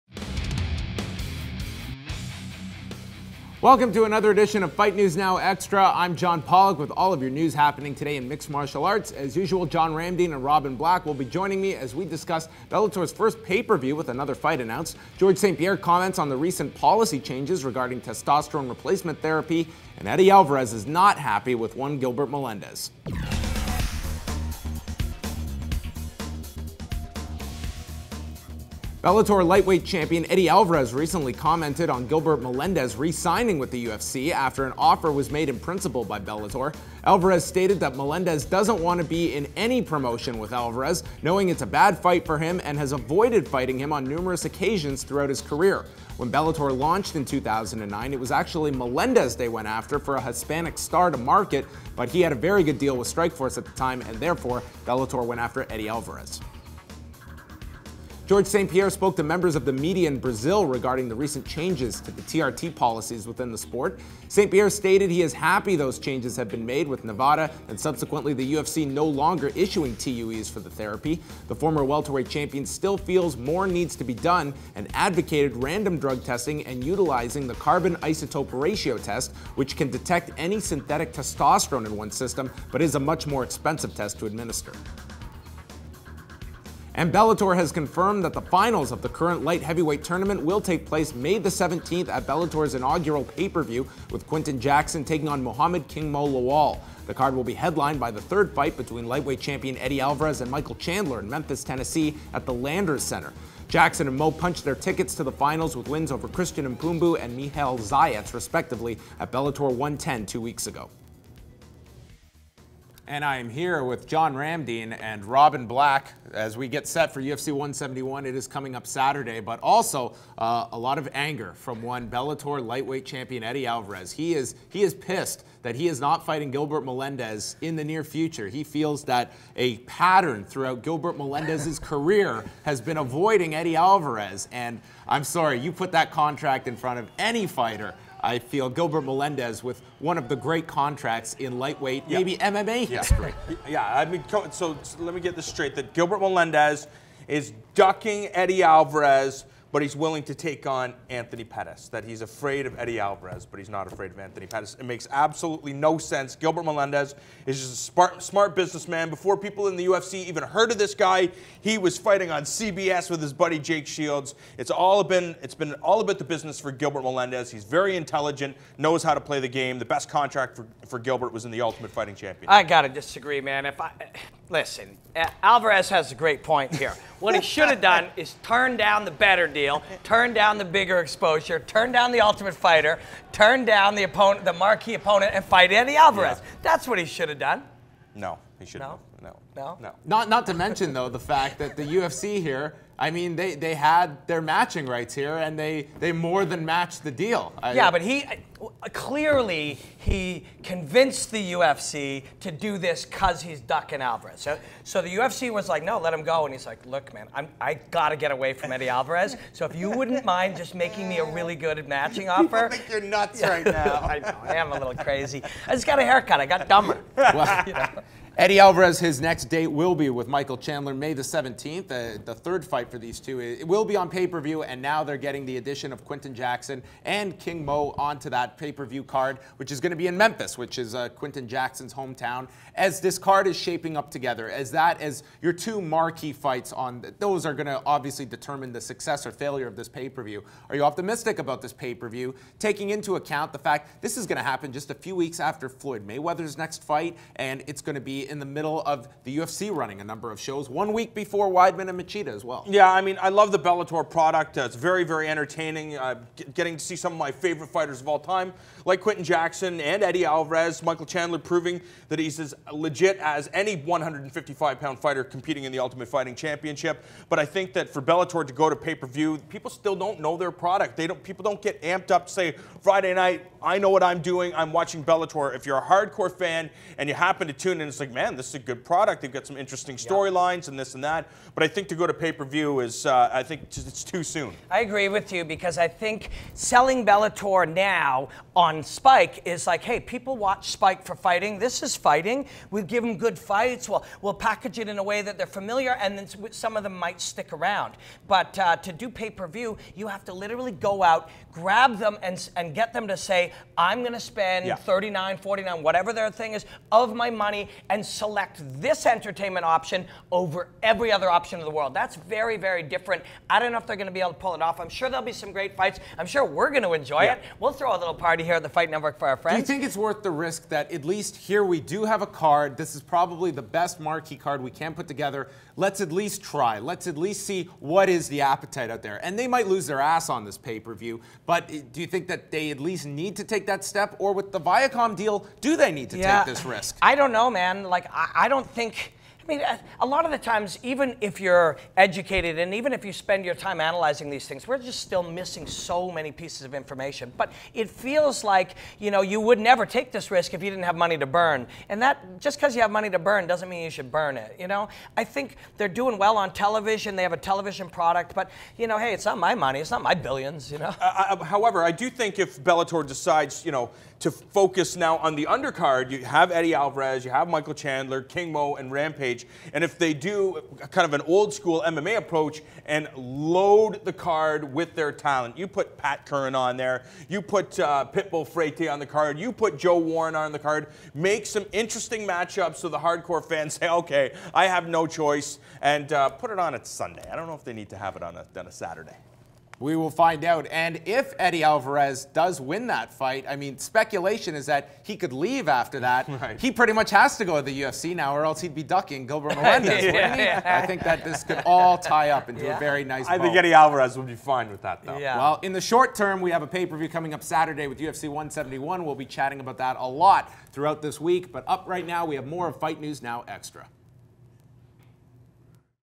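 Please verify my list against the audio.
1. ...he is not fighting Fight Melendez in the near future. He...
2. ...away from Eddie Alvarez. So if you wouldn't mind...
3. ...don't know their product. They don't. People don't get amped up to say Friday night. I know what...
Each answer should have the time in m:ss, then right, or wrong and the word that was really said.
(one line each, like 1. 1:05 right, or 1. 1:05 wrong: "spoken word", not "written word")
1. 2:05 wrong: "Gilbert", not "Fight"
2. 3:28 right
3. 4:29 right.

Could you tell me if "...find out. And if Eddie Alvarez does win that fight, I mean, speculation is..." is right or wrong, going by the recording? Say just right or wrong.
right.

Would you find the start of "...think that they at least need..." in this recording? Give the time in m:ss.
5:32.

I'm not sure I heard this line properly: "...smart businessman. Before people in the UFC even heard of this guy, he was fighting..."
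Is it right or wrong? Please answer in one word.
right.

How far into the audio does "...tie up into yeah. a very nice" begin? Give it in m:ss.
6:41.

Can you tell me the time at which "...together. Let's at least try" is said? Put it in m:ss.
5:25.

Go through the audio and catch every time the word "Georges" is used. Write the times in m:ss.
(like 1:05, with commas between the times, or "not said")
0:15, 0:58.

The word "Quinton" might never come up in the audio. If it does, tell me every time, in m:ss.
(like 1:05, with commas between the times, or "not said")
1:34, 3:46, 3:51, 4:19.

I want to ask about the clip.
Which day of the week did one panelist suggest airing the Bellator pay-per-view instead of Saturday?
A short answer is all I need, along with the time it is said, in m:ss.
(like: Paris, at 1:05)
Sunday, at 6:26.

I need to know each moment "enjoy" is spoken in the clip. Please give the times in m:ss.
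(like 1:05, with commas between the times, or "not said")
5:16.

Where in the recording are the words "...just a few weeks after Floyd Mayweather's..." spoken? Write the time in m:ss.
4:04.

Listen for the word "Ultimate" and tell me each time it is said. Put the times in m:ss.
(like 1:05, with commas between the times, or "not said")
2:51, 3:02, 4:25.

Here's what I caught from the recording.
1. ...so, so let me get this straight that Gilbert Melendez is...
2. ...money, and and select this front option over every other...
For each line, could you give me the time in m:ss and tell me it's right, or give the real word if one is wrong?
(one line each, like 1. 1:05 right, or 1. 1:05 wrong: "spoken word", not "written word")
1. 2:24 right
2. 5:07 wrong: "entertainment", not "front".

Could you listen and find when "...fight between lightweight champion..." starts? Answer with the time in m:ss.
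1:38.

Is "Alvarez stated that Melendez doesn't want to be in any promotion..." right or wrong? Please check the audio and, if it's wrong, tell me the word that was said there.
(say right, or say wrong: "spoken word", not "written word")
right.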